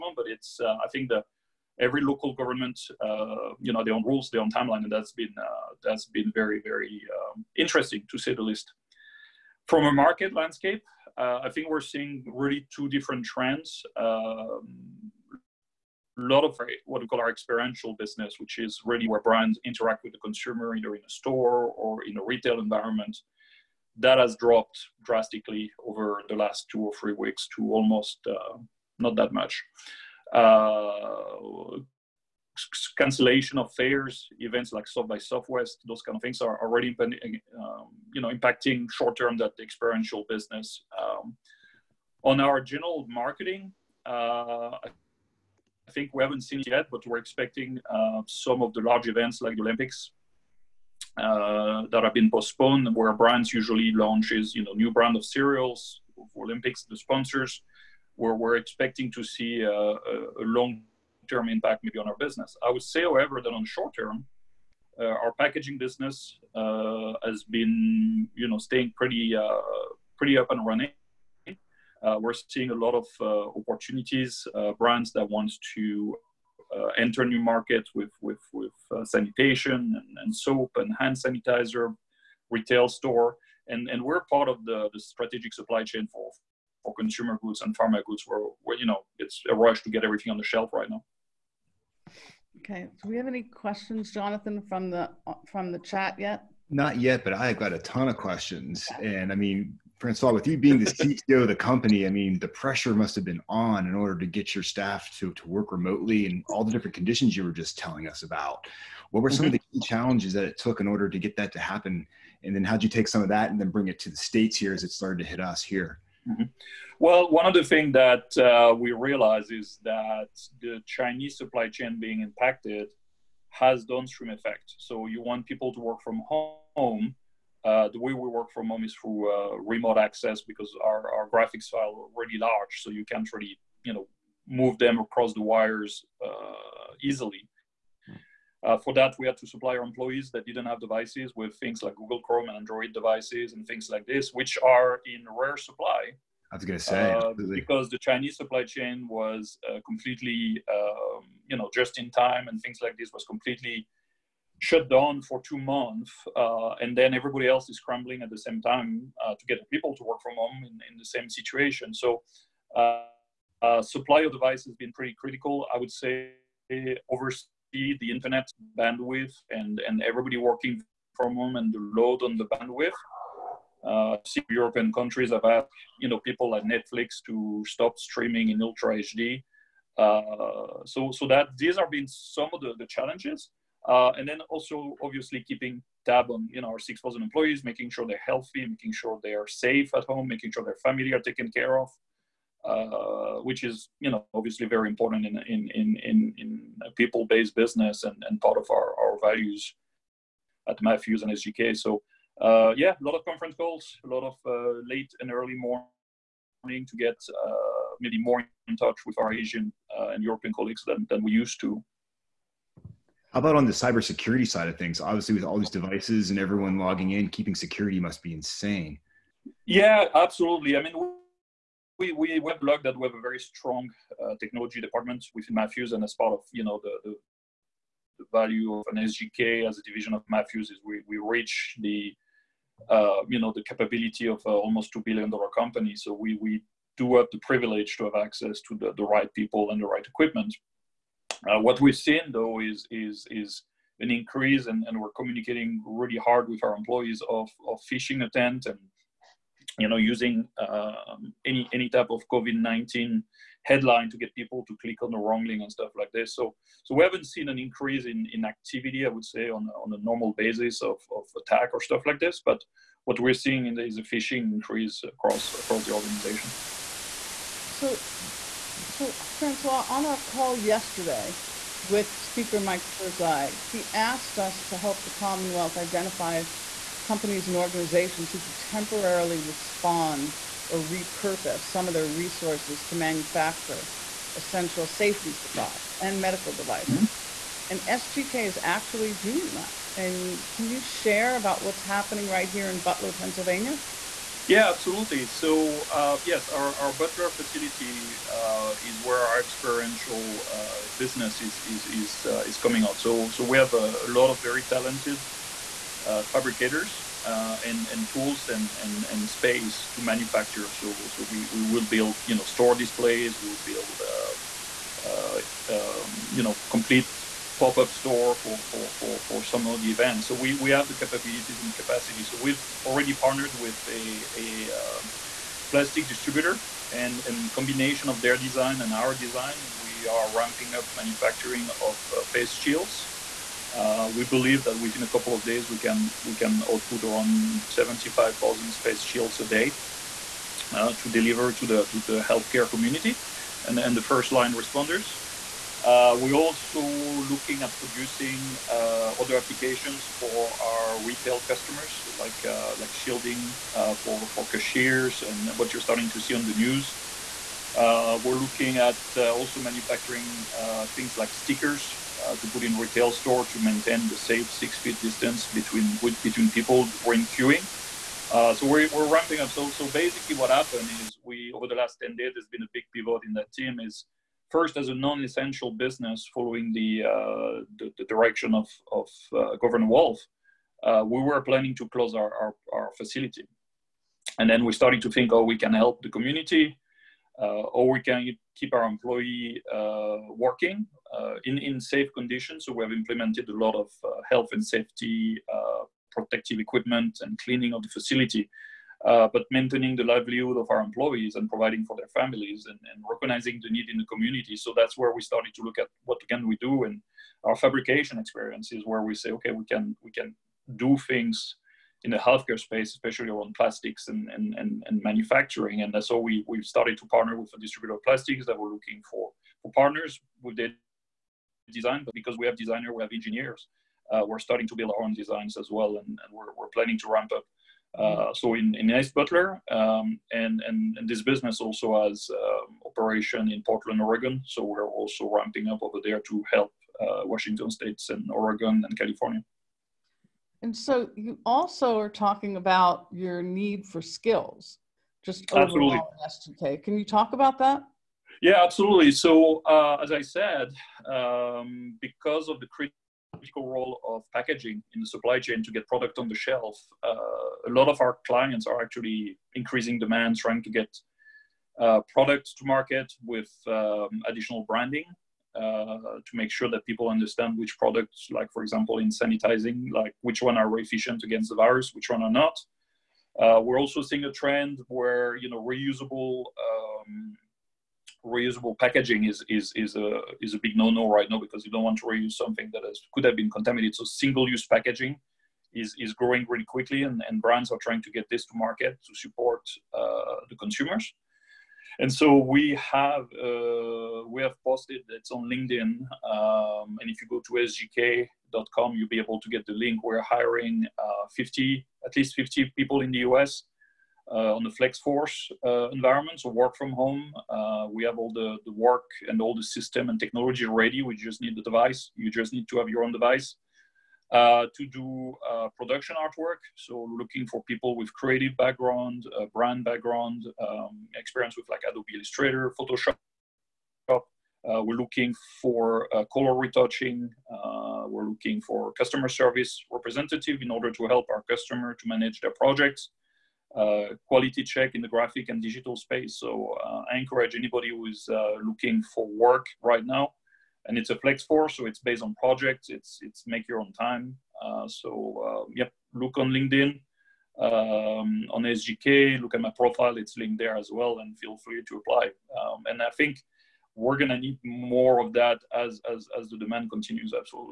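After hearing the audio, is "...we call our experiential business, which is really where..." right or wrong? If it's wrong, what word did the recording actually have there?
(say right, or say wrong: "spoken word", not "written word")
right.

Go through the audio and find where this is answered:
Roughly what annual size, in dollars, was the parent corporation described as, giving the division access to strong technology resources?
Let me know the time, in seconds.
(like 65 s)
234 s.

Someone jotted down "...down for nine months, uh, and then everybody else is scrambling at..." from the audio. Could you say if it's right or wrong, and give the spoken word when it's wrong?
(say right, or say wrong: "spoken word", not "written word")
wrong: "two", not "nine".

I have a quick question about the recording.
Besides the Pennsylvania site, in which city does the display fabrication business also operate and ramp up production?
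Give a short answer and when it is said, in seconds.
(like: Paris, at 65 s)
Portland, Oregon, at 433 s.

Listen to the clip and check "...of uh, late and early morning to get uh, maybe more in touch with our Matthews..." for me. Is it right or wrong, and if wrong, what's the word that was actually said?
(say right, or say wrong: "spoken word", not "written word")
wrong: "Asian", not "Matthews".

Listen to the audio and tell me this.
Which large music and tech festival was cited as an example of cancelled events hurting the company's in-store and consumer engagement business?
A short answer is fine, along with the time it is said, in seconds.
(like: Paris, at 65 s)
South by Southwest, at 34 s.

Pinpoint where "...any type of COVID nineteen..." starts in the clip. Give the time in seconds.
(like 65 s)
251 s.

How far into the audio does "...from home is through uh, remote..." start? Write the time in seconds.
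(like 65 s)
128 s.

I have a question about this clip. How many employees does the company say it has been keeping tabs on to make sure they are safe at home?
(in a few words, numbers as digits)
6,000.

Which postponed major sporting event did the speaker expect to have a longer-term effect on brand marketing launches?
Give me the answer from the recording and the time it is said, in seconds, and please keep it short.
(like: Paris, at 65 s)
the Olympics, at 49 s.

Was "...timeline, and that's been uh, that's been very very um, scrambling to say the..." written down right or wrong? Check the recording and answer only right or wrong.
wrong.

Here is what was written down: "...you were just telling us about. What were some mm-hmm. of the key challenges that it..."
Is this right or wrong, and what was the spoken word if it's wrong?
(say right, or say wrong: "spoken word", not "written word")
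right.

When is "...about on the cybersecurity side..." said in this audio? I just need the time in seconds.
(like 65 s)
213 s.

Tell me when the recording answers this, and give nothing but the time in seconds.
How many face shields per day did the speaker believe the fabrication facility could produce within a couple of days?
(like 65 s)
337 s.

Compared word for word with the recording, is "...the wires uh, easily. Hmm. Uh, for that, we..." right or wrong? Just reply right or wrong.
right.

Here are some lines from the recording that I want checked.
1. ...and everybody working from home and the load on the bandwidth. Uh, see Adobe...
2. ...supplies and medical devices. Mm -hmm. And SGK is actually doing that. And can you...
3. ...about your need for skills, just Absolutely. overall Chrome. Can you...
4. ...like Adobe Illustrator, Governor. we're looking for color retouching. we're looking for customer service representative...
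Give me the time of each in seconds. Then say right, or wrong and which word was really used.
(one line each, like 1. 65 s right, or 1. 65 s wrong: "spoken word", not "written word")
1. 169 s wrong: "European", not "Adobe"
2. 285 s right
3. 442 s wrong: "SGK", not "Chrome"
4. 521 s wrong: "Photoshop", not "Governor".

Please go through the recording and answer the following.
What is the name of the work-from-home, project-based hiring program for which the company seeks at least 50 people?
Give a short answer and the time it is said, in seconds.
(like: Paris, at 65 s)
Flexforce, at 504 s.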